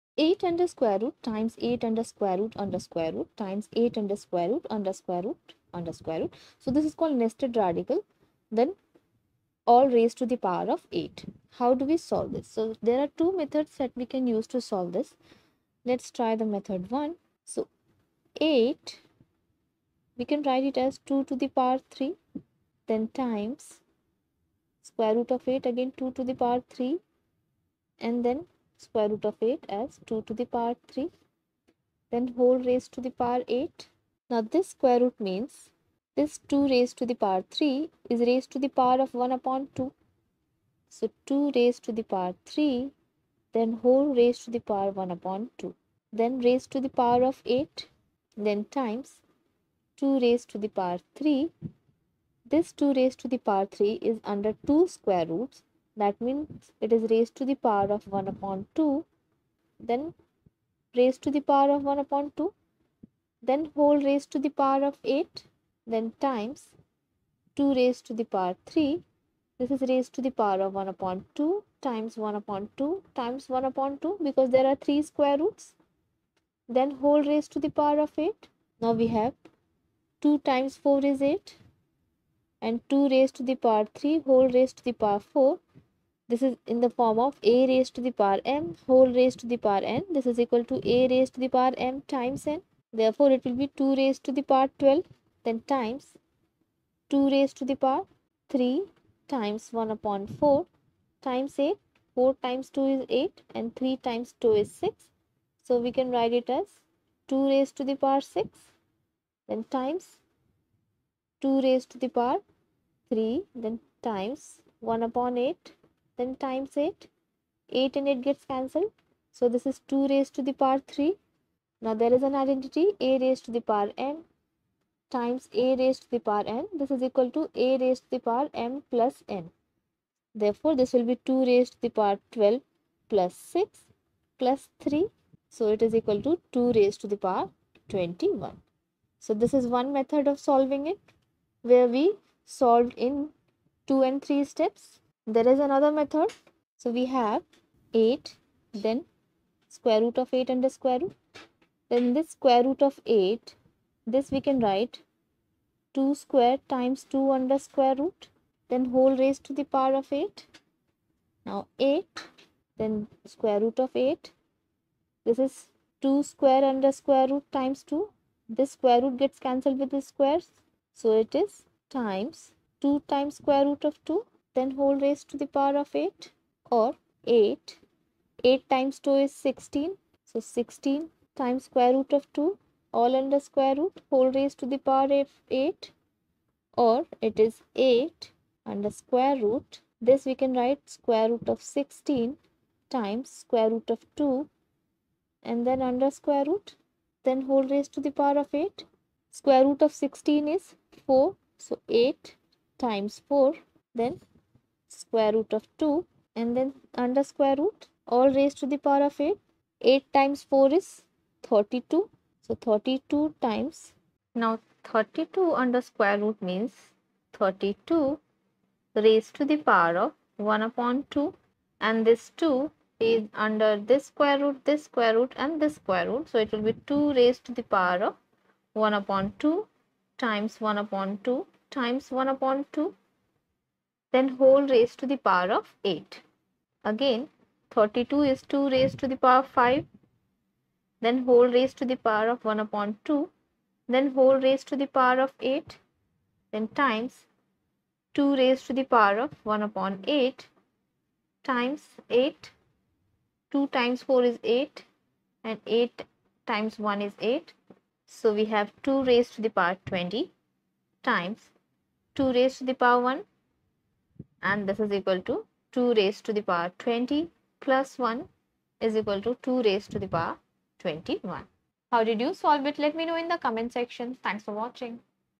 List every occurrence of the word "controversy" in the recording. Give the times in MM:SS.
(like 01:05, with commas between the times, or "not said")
not said.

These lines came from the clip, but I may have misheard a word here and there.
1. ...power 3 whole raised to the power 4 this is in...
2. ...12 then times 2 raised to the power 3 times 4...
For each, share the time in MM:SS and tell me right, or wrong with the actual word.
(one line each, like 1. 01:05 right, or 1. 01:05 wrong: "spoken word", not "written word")
1. 01:23 right
2. 01:34 wrong: "1", not "4".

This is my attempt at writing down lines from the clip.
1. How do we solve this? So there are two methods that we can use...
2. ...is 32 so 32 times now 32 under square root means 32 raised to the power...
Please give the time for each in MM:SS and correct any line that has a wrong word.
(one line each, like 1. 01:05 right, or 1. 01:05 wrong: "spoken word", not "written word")
1. 00:11 right
2. 03:30 right.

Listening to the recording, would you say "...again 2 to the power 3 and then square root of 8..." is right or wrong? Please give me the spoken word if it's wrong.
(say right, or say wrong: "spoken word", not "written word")
right.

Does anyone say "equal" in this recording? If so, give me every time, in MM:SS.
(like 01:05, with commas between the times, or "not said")
01:30, 02:07, 02:16, 04:24, 04:29.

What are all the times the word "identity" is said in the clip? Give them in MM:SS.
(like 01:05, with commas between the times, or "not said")
02:02.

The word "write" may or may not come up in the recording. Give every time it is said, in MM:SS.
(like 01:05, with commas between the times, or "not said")
00:20, 01:46, 02:34, 03:10.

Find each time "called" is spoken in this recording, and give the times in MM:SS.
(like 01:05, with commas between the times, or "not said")
00:06.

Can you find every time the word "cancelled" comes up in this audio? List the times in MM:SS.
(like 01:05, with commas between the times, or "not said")
01:58, 02:49.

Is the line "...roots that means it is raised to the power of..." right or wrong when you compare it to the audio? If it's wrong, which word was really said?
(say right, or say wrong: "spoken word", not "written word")
right.